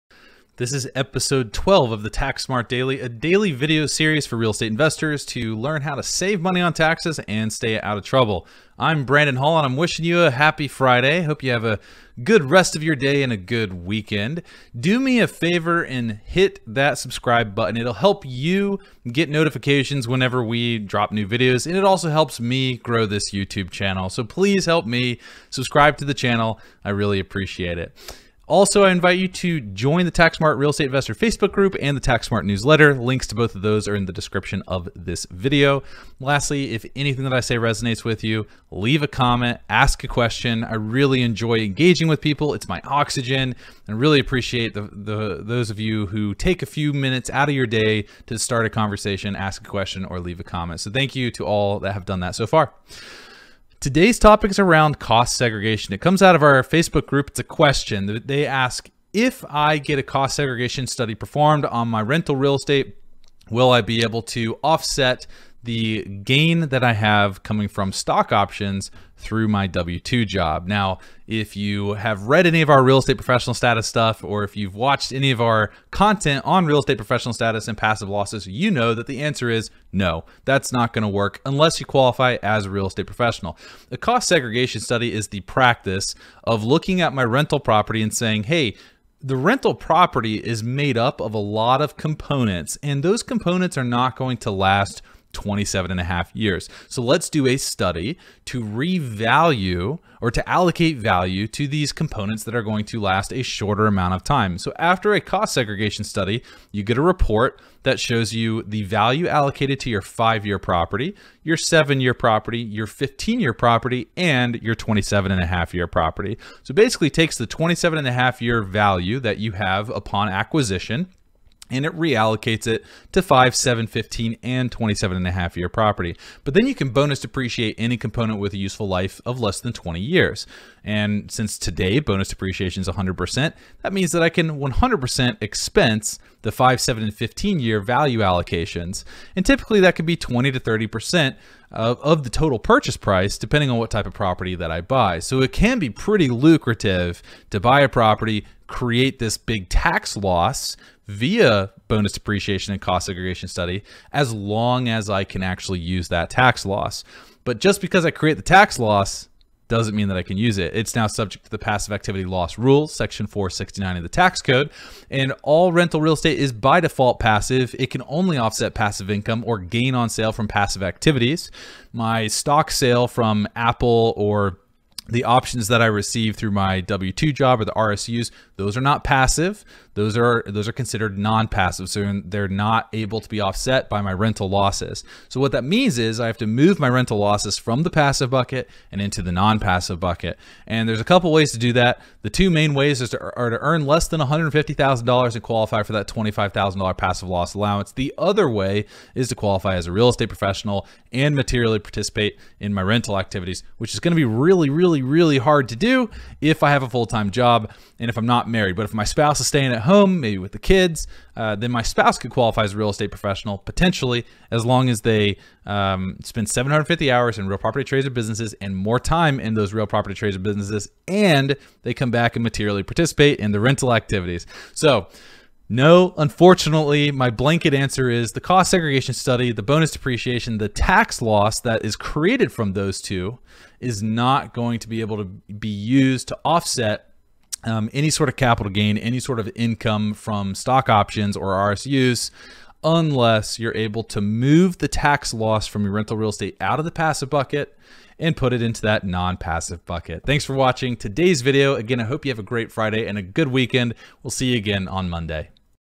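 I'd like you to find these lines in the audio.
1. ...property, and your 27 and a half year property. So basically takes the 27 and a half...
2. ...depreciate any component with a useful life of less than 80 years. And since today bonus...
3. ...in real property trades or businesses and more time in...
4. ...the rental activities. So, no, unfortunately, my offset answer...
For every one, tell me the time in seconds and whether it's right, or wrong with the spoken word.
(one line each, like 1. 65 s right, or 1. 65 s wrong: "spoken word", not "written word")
1. 113 s right
2. 127 s wrong: "20", not "80"
3. 217 s right
4. 223 s wrong: "blanket", not "offset".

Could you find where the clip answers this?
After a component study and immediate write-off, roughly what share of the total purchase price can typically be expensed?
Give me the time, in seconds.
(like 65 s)
140 s.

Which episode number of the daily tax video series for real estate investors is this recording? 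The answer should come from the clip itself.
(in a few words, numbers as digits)
12.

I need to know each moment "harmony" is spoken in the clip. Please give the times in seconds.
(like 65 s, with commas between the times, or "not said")
not said.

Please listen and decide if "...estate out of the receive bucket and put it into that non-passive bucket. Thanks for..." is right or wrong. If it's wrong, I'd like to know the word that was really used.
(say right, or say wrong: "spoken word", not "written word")
wrong: "passive", not "receive".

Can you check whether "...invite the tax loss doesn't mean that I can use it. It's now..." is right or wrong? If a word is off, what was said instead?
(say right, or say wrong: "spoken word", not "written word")
wrong: "create", not "invite".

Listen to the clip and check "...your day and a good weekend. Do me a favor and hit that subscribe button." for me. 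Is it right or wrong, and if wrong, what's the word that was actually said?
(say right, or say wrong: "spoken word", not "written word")
right.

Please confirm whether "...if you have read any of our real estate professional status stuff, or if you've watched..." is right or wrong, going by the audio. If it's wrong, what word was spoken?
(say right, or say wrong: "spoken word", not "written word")
right.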